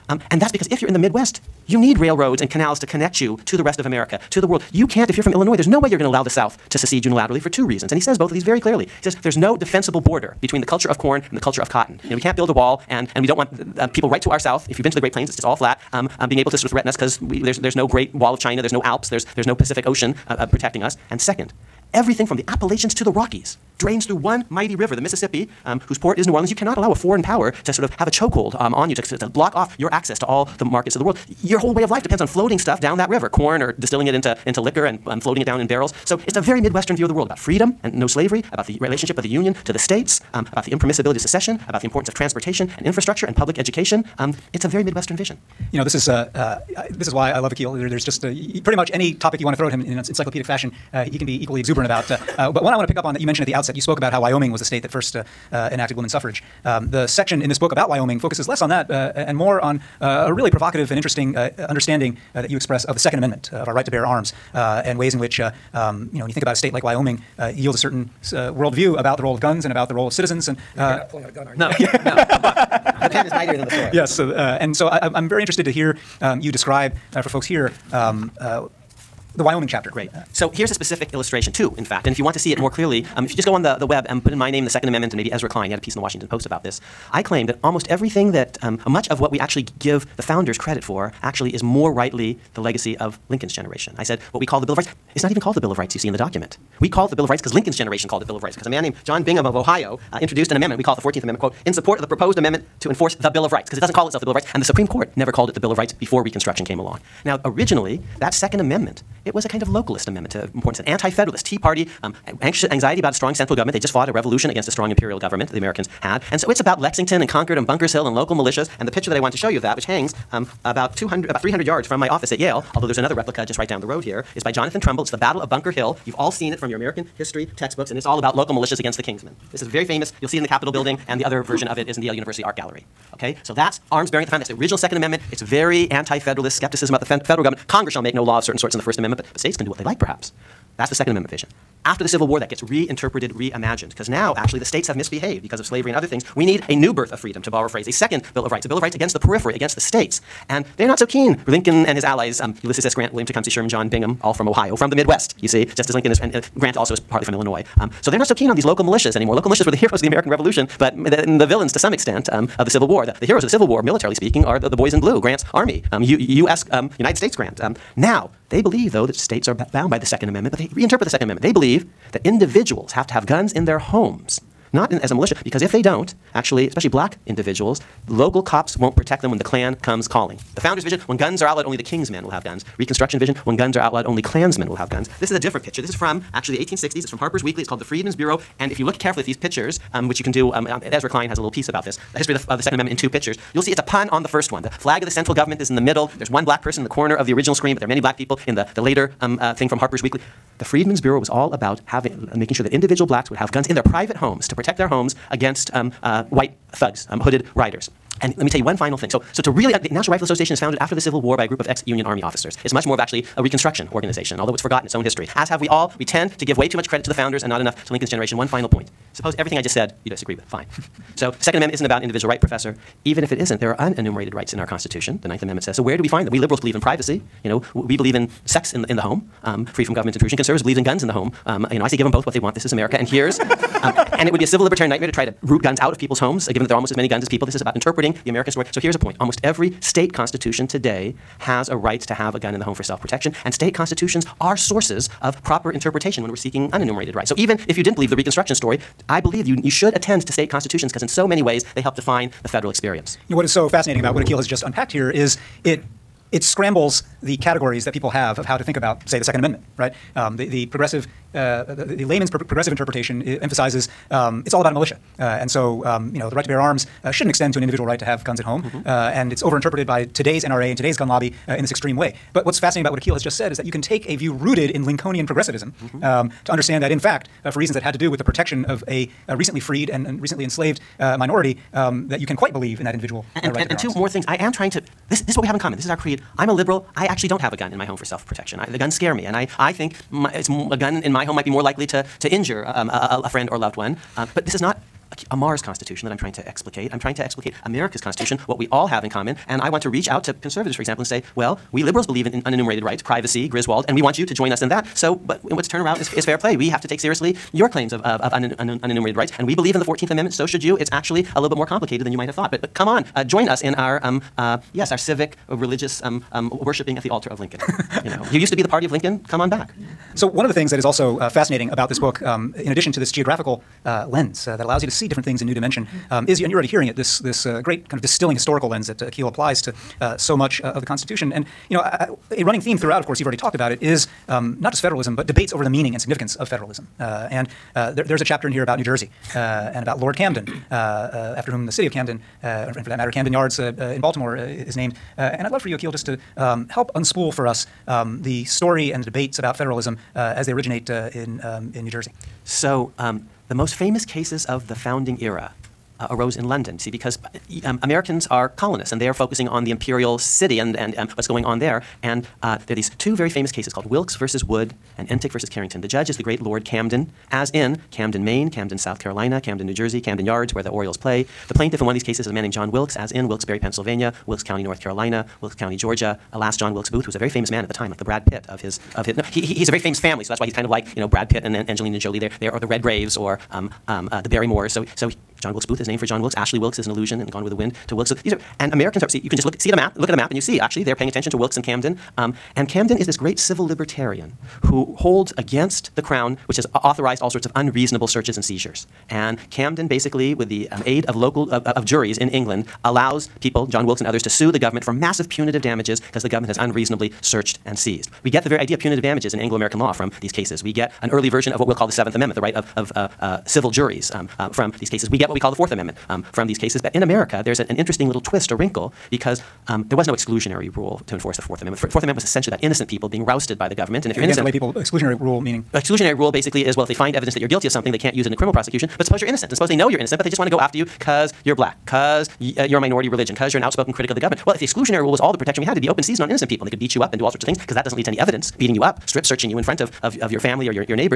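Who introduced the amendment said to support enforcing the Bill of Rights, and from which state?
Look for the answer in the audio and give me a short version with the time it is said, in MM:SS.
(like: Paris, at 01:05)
John Bingham of Ohio, at 01:39.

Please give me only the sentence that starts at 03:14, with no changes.
The flag of the central government is in the middle.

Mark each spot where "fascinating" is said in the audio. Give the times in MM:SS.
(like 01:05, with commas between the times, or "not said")
04:13, 04:32, 05:21.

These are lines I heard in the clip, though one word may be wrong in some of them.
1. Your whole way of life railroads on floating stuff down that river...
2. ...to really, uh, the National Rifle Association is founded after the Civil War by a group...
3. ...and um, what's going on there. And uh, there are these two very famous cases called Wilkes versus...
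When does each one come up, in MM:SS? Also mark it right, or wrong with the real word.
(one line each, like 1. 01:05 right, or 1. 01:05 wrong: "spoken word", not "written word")
1. 00:31 wrong: "depends", not "railroads"
2. 03:29 right
3. 06:00 right.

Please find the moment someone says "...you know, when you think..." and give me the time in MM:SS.
01:06.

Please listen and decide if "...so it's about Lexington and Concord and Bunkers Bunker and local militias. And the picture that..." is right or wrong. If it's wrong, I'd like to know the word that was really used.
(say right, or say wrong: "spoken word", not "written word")
wrong: "Hill", not "Bunker".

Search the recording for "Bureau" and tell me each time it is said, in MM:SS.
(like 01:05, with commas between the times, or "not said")
03:08, 03:20.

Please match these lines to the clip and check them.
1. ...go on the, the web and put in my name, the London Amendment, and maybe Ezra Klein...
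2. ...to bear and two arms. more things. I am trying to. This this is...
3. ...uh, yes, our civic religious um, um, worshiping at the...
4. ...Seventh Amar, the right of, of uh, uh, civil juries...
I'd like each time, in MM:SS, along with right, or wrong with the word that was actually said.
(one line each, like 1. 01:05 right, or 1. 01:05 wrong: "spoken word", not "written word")
1. 01:23 wrong: "Second", not "London"
2. 04:43 right
3. 05:14 right
4. 06:51 wrong: "Amendment", not "Amar".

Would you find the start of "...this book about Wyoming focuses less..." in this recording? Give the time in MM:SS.
00:57.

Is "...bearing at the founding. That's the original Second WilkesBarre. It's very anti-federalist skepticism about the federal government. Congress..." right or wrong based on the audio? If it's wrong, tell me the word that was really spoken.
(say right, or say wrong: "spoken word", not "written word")
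wrong: "Amendment", not "WilkesBarre".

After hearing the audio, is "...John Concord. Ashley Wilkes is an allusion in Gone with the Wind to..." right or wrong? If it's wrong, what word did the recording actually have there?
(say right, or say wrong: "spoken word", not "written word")
wrong: "Wilkes", not "Concord".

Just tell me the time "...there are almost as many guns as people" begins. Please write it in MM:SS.
03:56.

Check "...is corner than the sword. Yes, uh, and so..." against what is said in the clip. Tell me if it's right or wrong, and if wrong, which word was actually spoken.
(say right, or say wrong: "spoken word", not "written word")
wrong: "mightier", not "corner".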